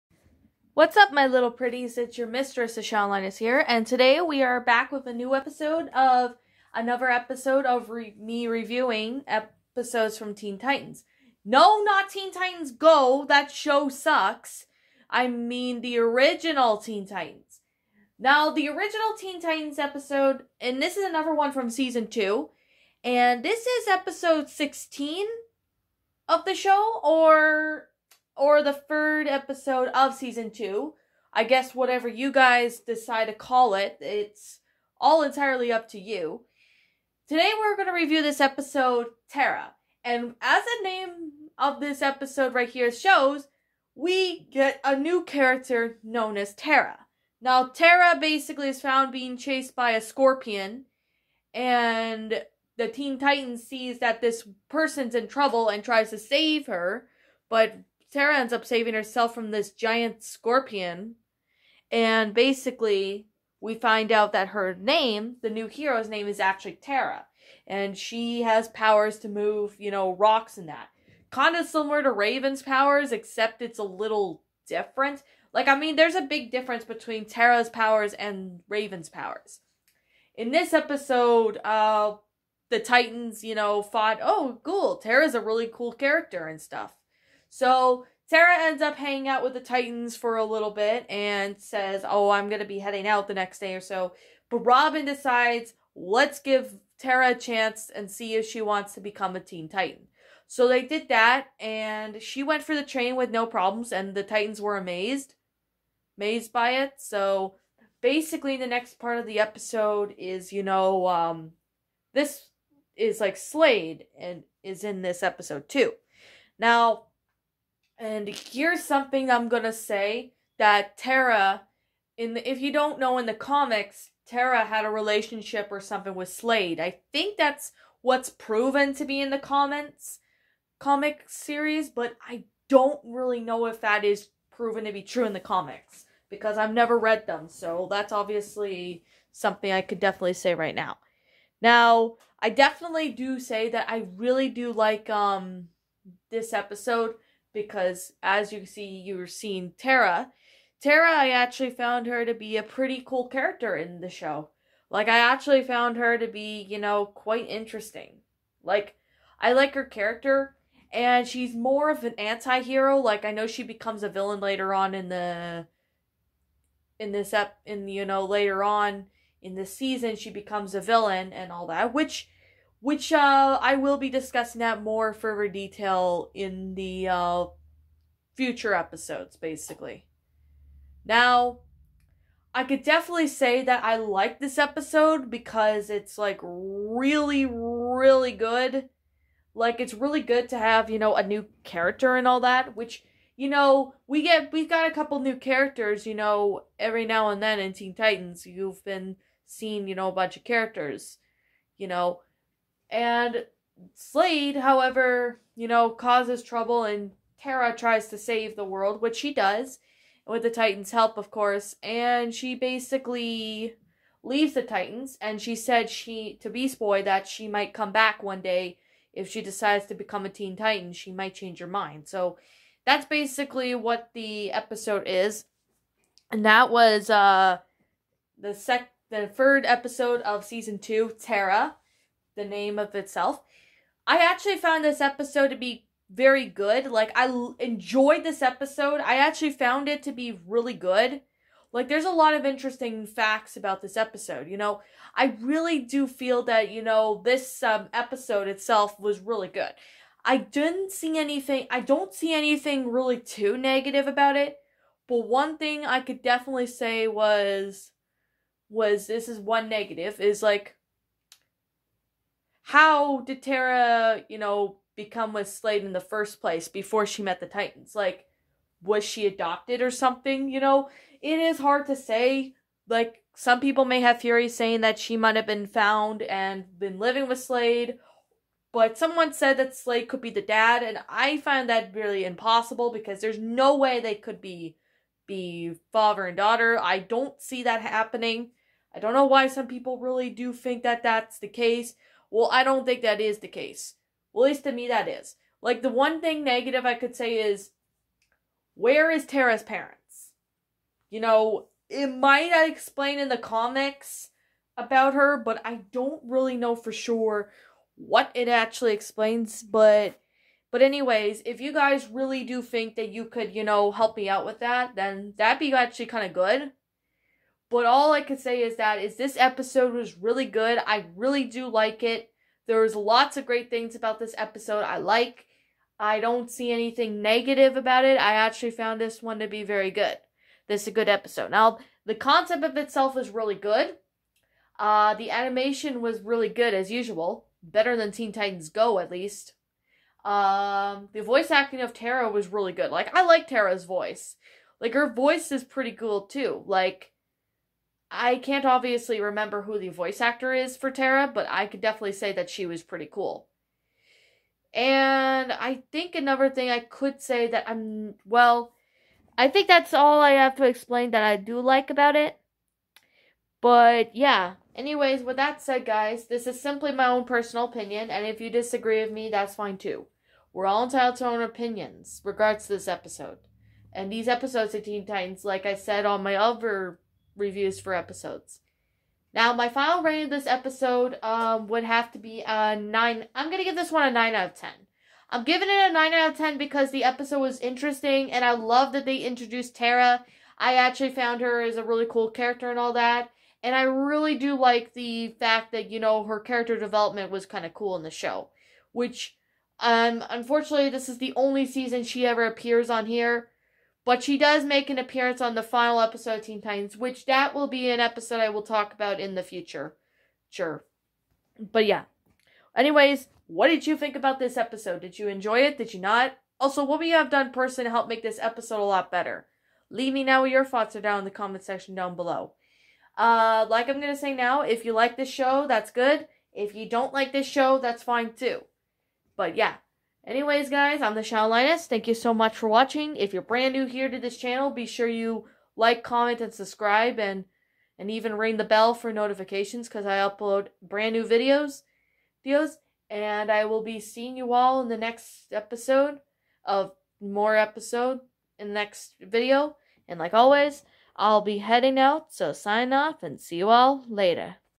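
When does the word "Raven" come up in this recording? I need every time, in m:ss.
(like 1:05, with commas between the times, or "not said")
1:12, 1:18.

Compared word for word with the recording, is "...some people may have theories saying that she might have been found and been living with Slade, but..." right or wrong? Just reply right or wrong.
right.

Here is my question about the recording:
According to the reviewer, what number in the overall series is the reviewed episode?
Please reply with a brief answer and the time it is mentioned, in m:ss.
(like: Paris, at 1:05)
16, at 0:23.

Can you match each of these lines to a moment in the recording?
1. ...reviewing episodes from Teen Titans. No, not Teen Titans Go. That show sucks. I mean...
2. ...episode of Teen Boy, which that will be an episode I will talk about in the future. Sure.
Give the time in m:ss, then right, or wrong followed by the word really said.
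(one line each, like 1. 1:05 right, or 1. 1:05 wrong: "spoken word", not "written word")
1. 0:08 right
2. 6:46 wrong: "Titans", not "Boy".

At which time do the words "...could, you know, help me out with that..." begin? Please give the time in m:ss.
5:13.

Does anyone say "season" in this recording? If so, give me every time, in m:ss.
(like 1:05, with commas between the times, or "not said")
0:21, 0:30, 2:49, 3:50, 6:41.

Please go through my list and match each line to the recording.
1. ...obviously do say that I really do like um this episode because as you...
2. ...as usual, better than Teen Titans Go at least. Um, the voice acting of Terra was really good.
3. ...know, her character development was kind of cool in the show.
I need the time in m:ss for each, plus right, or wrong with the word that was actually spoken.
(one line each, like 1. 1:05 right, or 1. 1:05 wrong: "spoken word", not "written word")
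1. 2:22 wrong: "definitely", not "obviously"
2. 5:36 right
3. 6:35 right.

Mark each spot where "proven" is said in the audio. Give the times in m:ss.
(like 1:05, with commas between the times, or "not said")
2:08, 2:14.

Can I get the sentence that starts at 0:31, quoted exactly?
I guess whatever you guys decide to call it, it's all entirely up to you.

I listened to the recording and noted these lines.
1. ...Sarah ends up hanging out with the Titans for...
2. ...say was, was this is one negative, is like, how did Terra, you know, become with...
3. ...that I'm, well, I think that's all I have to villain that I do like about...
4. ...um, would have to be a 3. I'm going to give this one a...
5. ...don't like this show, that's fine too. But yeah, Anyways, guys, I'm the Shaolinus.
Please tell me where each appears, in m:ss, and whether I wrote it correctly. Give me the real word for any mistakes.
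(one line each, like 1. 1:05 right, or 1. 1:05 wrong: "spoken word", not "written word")
1. 1:28 right
2. 4:16 right
3. 5:57 wrong: "explain", not "villain"
4. 6:21 wrong: "9", not "3"
5. 7:06 right.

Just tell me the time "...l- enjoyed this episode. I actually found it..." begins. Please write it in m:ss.
3:57.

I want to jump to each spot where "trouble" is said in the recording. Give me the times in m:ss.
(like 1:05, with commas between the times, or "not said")
0:55, 3:26.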